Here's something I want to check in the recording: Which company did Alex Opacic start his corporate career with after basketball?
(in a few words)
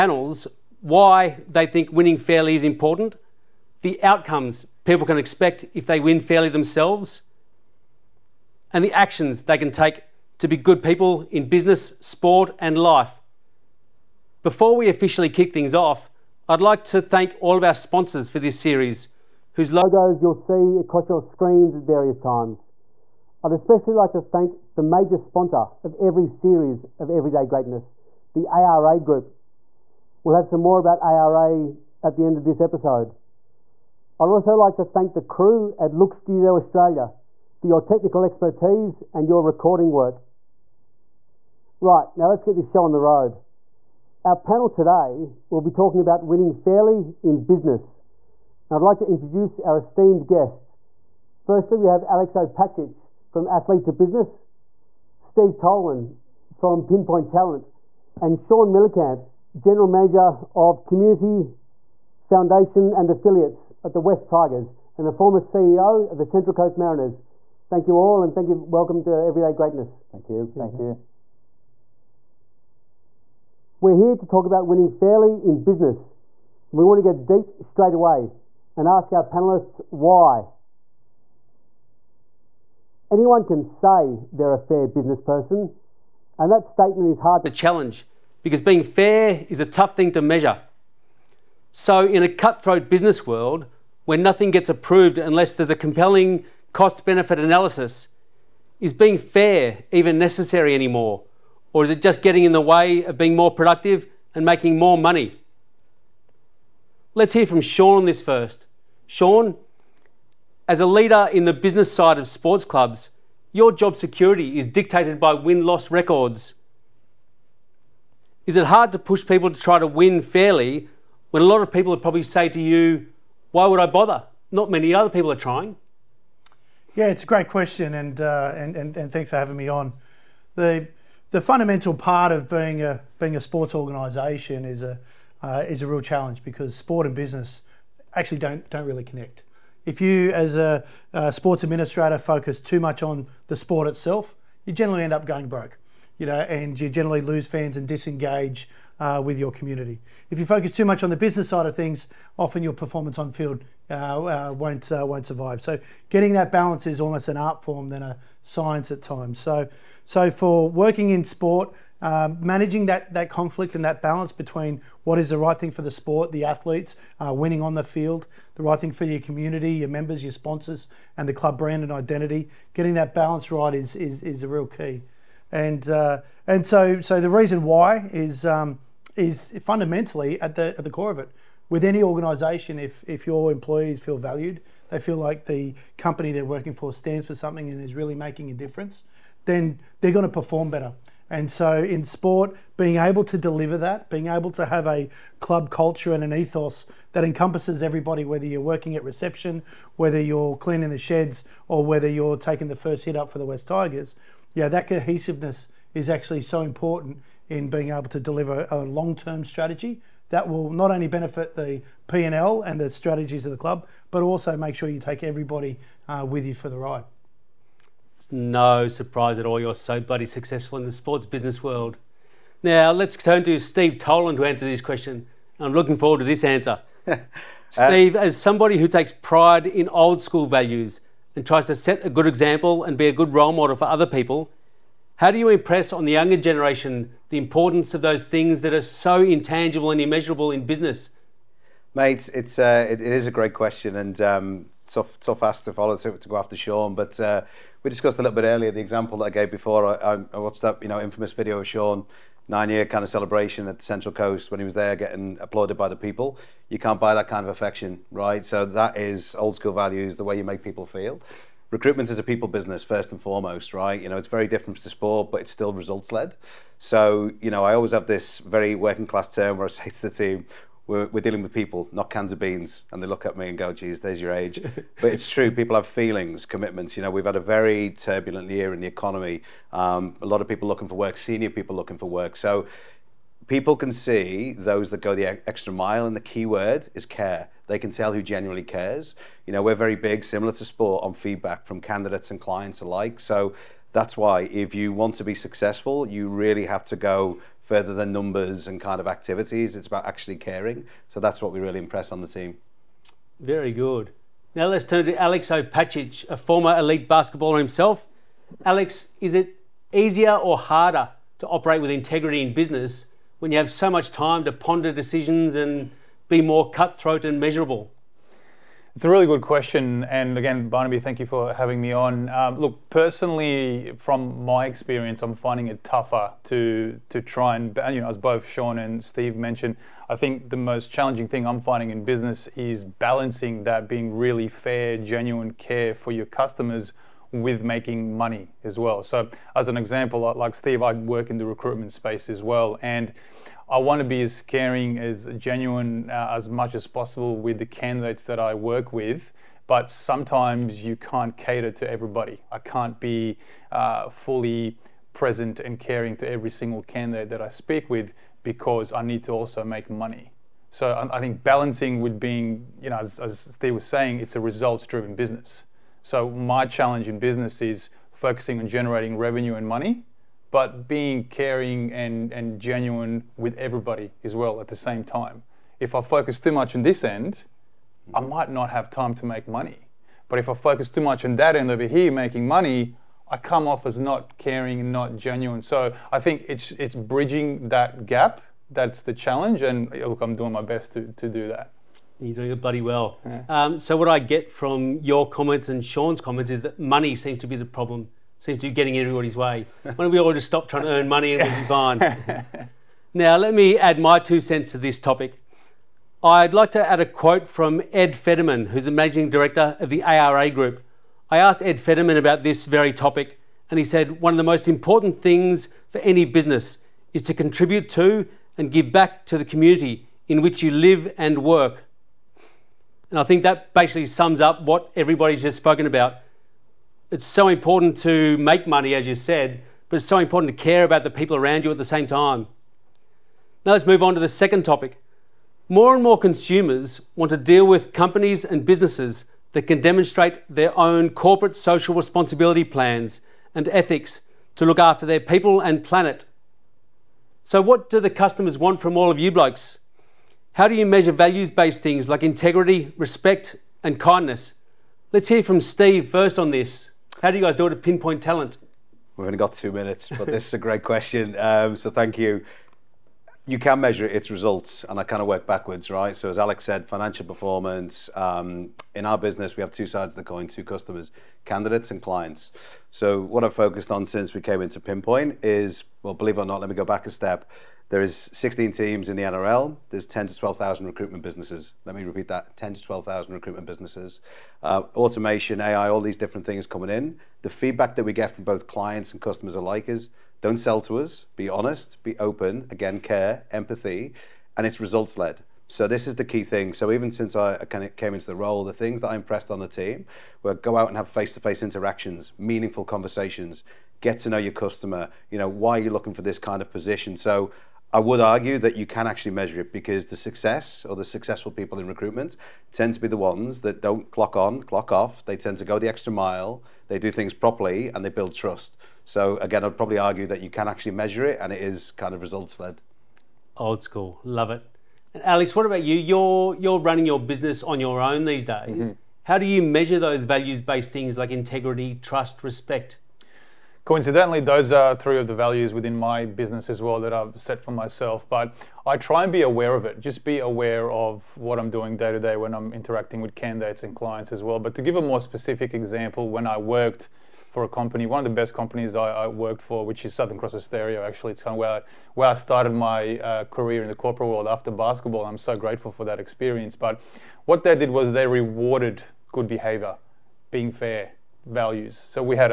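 Southern Cross Austereo.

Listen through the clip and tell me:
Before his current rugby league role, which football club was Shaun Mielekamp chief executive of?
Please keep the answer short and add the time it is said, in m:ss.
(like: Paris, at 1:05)
Central Coast Mariners, at 1:06.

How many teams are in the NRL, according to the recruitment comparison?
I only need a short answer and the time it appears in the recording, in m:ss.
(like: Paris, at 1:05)
16, at 7:58.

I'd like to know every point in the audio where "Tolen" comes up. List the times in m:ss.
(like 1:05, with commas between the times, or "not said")
0:55, 3:43.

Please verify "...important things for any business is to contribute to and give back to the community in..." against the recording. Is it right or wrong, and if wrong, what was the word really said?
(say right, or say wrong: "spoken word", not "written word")
right.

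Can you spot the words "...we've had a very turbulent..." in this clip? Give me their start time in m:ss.
4:37.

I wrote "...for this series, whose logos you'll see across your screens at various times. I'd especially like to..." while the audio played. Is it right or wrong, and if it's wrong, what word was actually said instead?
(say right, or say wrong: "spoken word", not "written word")
right.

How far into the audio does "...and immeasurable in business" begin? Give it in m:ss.
3:59.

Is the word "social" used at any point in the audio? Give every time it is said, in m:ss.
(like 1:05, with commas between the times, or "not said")
7:21.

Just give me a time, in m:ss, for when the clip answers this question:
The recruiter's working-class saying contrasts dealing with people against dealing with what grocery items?
4:32.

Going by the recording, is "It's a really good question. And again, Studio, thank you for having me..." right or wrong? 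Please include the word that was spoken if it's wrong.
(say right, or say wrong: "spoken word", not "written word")
wrong: "Barnaby", not "Studio".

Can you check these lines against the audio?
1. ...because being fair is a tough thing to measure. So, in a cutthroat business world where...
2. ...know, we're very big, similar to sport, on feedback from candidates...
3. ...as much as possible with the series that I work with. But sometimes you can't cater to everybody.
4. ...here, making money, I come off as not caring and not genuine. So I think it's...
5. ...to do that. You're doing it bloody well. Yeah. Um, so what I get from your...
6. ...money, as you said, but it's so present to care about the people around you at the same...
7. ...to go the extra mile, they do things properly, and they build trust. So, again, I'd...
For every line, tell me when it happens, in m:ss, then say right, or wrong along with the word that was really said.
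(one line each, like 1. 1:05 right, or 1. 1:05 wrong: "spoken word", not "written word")
1. 1:28 right
2. 4:49 right
3. 5:46 wrong: "candidates", not "series"
4. 6:21 right
5. 6:31 right
6. 7:08 wrong: "important", not "present"
7. 8:35 right.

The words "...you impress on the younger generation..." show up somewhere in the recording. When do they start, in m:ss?
3:55.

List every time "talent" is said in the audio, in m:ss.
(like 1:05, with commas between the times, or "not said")
0:57, 7:38.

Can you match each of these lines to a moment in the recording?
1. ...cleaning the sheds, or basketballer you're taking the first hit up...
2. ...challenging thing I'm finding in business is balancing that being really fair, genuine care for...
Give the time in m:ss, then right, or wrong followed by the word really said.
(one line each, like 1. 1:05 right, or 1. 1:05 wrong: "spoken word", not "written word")
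1. 3:20 wrong: "whether", not "basketballer"
2. 5:30 right.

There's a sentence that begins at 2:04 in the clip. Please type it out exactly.
Not many other people are trying.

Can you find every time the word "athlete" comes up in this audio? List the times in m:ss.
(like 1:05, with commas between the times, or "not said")
0:53, 2:46.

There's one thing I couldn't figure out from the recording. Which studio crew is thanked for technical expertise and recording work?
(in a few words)
Look Studio Australia.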